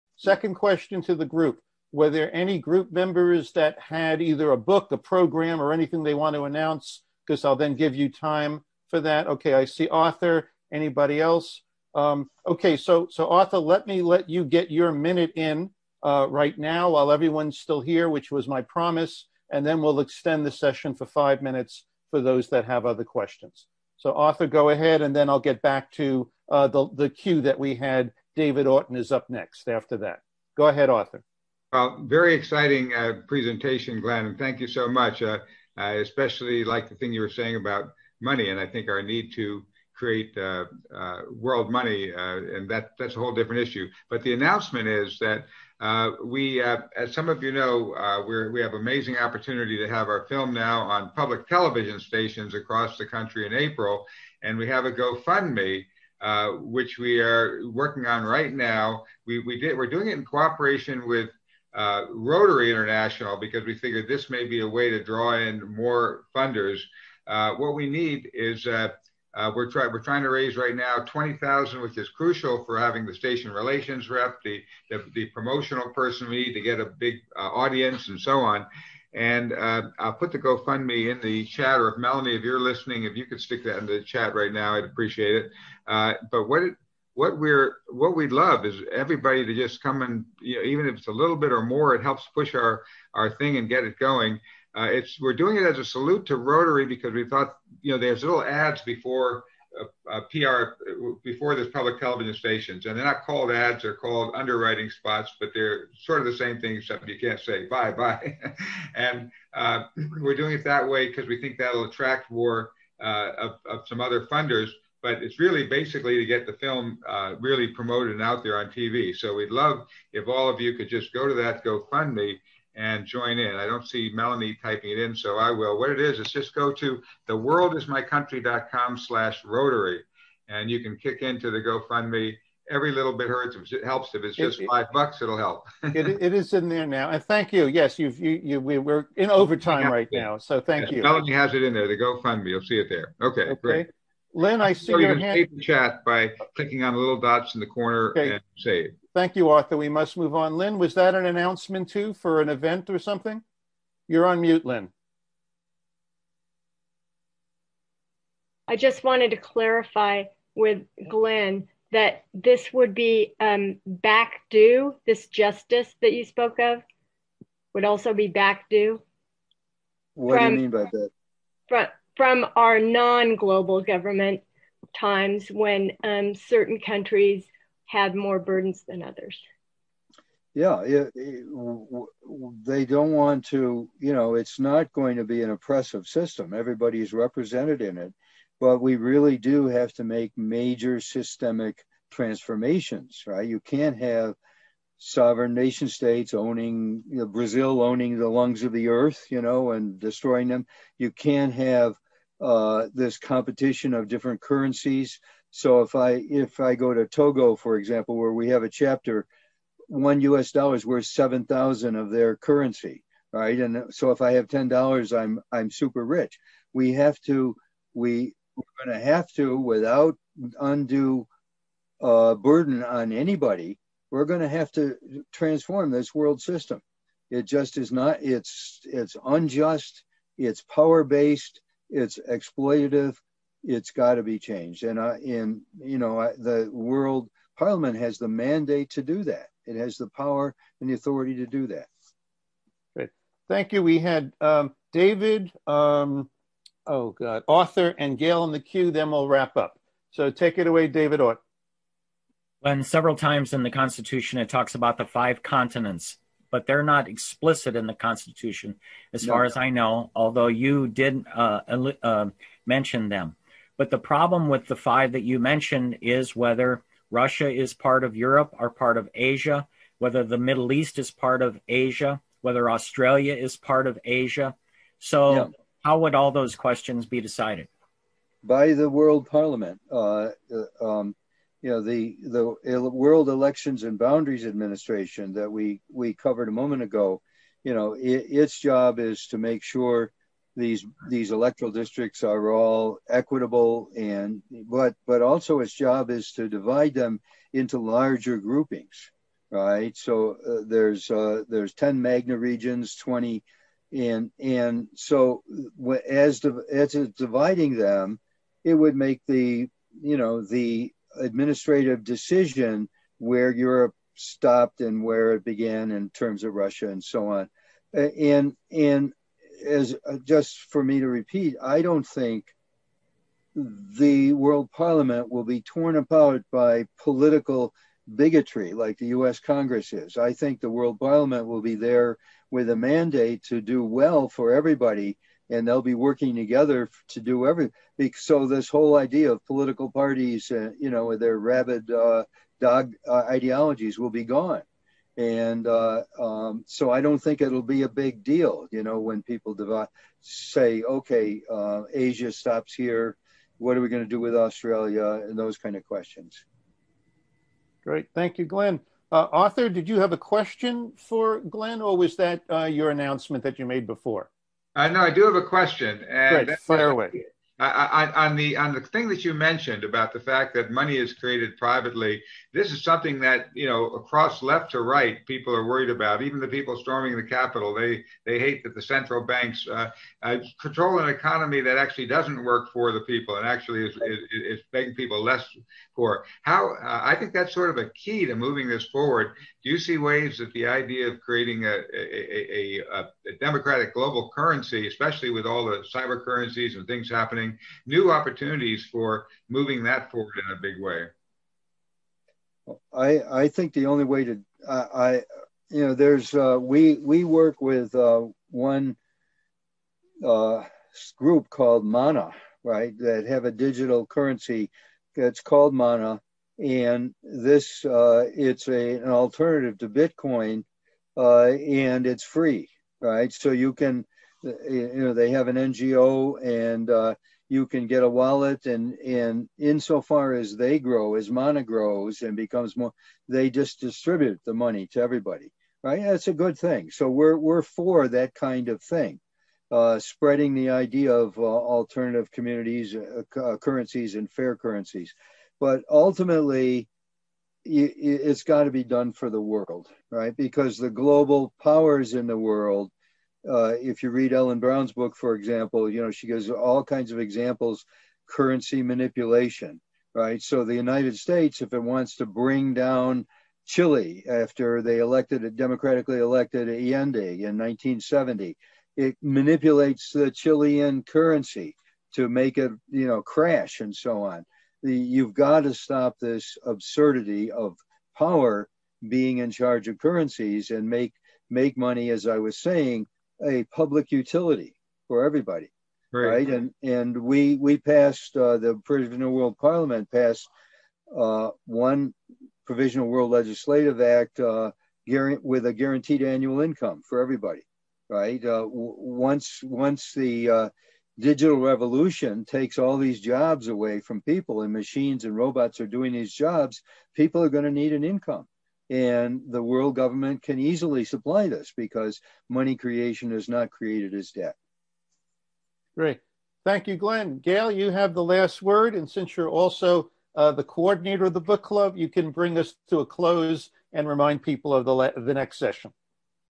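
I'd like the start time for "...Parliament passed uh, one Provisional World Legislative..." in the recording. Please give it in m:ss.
8:09.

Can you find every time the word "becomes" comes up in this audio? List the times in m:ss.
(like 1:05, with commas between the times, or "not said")
7:12.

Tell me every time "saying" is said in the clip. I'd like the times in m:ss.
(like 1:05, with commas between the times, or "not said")
0:37, 8:02.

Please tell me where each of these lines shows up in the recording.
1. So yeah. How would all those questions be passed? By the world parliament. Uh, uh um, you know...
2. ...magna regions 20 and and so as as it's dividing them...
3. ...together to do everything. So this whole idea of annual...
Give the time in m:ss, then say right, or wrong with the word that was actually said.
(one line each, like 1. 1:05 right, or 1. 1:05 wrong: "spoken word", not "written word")
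1. 4:34 wrong: "decided", not "passed"
2. 5:02 right
3. 5:36 wrong: "political", not "annual".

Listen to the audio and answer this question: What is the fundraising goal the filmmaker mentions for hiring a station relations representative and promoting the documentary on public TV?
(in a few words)
20,000.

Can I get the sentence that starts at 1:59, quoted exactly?
So we'd love if all of you could just go to that GoFundMe and join in.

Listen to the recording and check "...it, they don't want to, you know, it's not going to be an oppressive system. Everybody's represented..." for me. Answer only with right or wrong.
right.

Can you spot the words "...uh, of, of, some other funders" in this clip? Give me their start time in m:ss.
1:53.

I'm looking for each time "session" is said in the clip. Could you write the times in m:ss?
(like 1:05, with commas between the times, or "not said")
0:20, 8:45.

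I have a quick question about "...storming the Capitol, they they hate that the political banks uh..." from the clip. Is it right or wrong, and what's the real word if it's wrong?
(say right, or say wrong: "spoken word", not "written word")
wrong: "central", not "political".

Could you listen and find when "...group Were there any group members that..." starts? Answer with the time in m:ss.
0:01.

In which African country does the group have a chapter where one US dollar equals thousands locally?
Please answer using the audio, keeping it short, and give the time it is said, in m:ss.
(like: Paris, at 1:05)
Togo, at 3:27.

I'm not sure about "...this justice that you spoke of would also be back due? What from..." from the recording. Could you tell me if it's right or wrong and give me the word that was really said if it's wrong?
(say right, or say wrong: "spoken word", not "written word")
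right.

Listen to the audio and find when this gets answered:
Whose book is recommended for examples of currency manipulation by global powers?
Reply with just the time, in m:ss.
7:34.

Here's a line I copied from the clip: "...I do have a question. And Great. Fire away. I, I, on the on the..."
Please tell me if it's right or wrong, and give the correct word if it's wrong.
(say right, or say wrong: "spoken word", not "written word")
right.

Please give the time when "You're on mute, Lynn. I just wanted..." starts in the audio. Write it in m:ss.
2:34.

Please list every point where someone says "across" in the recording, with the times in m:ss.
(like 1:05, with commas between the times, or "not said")
0:52, 6:13.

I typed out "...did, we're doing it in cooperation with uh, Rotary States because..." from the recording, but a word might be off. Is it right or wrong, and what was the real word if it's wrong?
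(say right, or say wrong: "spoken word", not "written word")
wrong: "International", not "States".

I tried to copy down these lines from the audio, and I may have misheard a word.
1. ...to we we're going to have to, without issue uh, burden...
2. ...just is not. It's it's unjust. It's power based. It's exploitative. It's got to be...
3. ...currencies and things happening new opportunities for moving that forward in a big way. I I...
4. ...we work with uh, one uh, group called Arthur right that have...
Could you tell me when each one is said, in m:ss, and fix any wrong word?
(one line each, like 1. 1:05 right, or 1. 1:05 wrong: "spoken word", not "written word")
1. 3:37 wrong: "undue", not "issue"
2. 3:47 right
3. 6:36 right
4. 6:46 wrong: "Manna", not "Arthur".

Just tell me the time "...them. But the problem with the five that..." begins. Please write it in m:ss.
4:23.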